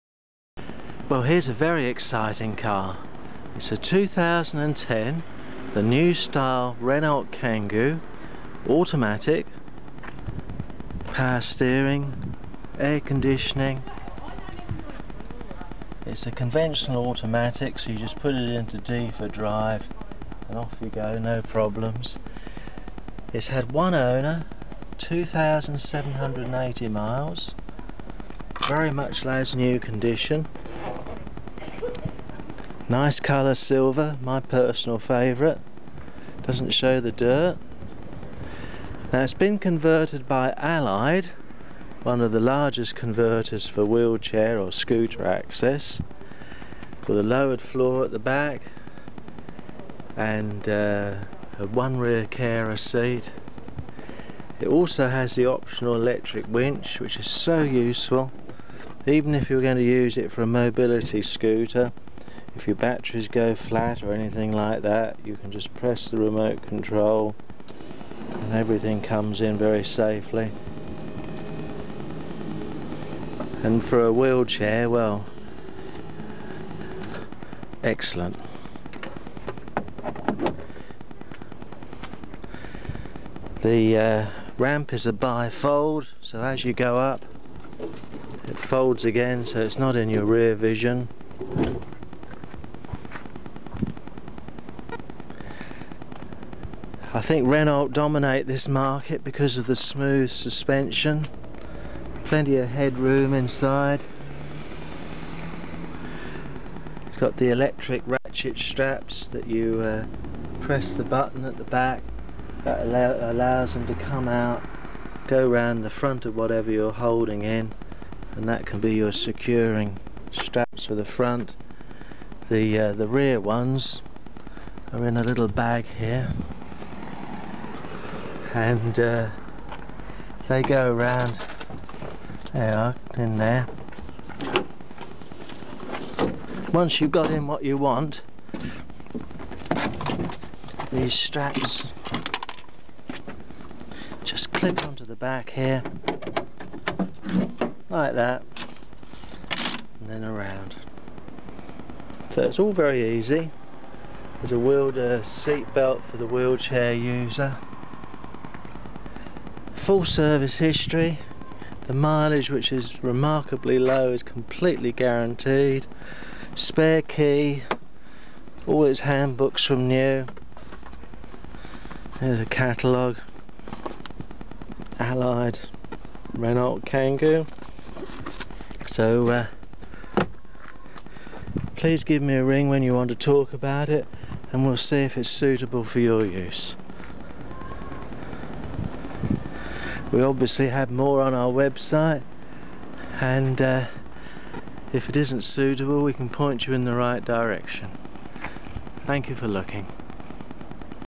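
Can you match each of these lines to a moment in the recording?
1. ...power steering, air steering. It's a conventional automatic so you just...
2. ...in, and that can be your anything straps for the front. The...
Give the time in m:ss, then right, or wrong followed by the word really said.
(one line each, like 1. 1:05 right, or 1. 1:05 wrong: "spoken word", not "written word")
1. 0:11 wrong: "conditioning", not "steering"
2. 1:57 wrong: "securing", not "anything".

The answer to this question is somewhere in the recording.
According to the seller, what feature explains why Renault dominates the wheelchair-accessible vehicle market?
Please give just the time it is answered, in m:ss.
1:39.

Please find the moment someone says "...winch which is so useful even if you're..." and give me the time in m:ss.
0:56.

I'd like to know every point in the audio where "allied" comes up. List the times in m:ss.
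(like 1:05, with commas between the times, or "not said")
0:40, 2:54.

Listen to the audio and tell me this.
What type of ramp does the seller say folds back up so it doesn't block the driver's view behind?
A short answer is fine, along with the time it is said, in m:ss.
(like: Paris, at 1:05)
Bifold, at 1:25.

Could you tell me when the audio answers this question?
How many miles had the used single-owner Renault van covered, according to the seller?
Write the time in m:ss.
0:24.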